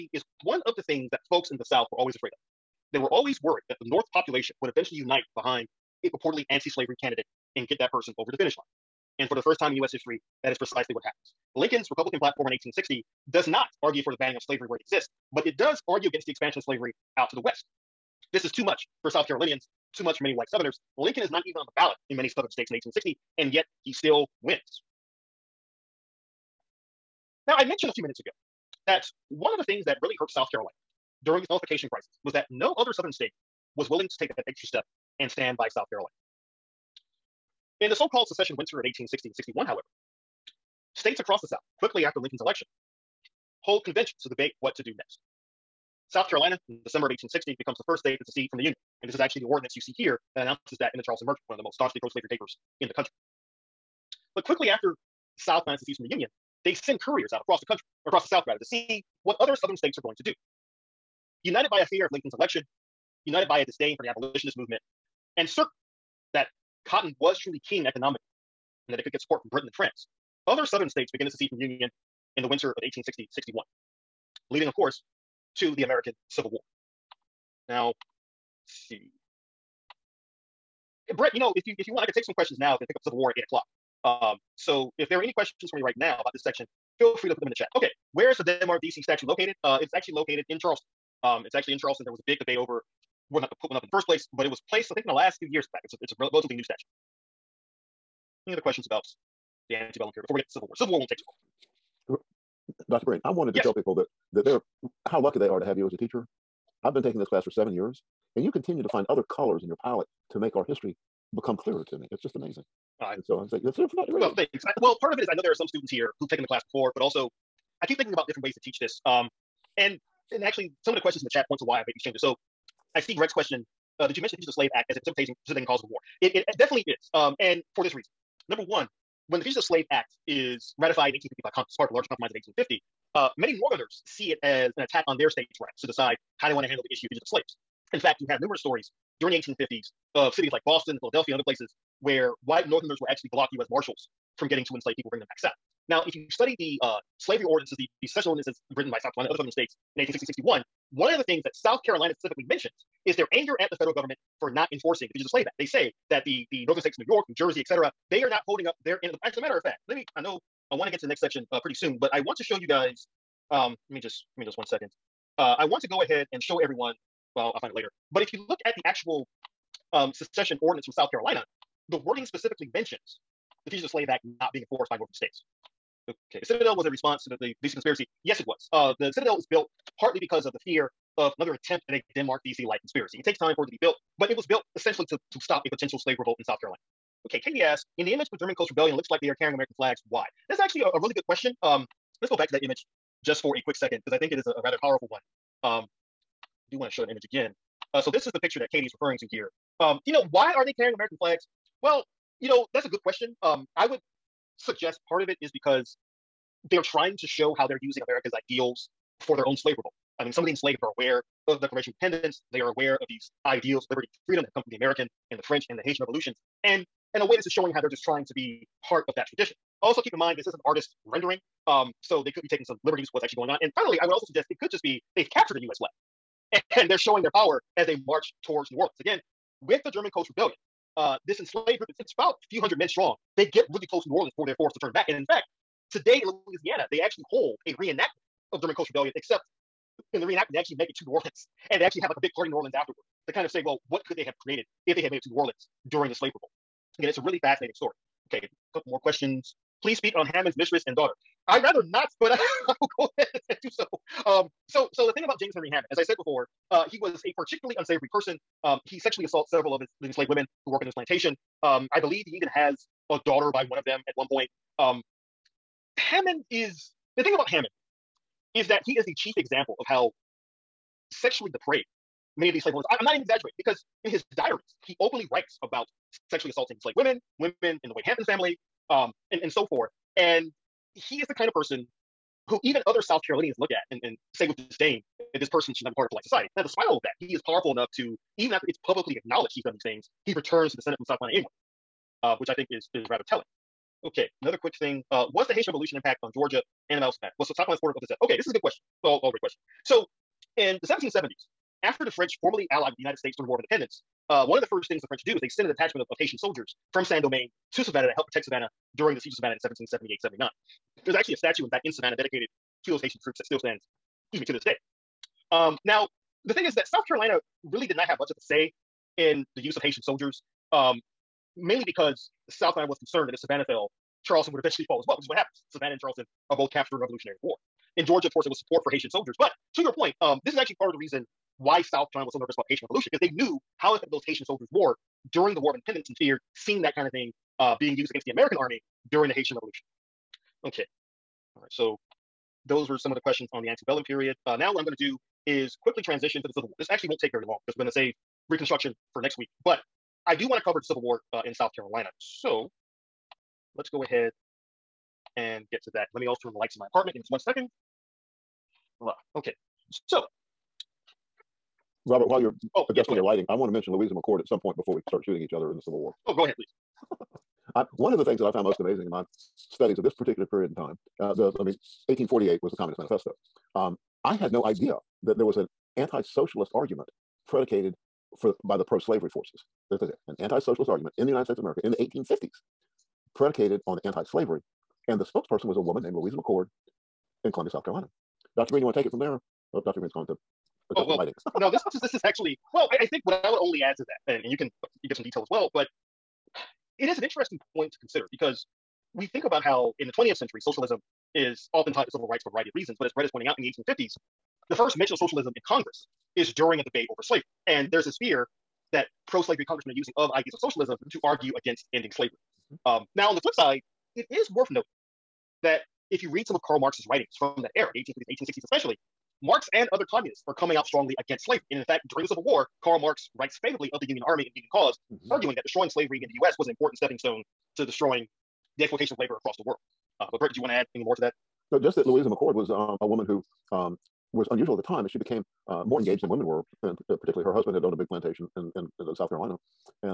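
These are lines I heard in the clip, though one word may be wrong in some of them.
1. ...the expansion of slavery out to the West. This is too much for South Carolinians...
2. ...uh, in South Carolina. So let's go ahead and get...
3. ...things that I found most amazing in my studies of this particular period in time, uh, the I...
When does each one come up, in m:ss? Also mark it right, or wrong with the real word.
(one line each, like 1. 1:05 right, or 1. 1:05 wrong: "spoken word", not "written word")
1. 0:16 right
2. 5:51 right
3. 6:08 right.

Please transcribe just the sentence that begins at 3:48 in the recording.
Again, with the German Coast Rebellion, uh, this enslaved group, it's, it's about a few hundred men strong.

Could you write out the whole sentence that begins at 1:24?
Um, so if there are any questions for me right now about this section, feel free to put them in the chat.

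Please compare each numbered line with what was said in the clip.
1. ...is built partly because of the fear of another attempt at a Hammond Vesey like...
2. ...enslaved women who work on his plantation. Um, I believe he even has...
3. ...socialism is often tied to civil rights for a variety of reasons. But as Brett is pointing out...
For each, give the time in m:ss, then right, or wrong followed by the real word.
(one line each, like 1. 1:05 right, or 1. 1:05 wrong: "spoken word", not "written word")
1. 2:59 wrong: "Denmark", not "Hammond"
2. 4:20 right
3. 6:40 right.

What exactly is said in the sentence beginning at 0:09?
And for the first time in US history, that is precisely what happens.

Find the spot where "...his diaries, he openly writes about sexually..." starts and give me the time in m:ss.
4:34.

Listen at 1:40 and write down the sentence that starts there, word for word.
Civil War won't take too long.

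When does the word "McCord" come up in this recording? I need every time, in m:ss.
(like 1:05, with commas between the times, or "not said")
6:04, 6:26, 7:12.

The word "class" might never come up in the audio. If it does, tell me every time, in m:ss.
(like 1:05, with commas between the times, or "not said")
1:47, 1:56.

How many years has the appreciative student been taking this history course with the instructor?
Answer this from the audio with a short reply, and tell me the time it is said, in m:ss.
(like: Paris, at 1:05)
7, at 1:47.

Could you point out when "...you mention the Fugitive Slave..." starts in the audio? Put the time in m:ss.
2:04.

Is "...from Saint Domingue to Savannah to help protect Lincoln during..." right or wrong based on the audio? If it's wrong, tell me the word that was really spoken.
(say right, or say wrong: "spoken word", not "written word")
wrong: "Savannah", not "Lincoln".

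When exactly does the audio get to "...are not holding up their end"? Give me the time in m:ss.
2:38.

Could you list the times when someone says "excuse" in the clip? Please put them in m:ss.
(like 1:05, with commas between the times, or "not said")
5:14.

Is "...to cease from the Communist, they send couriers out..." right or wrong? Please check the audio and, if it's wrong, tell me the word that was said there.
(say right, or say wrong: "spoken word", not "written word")
wrong: "Union", not "Communist".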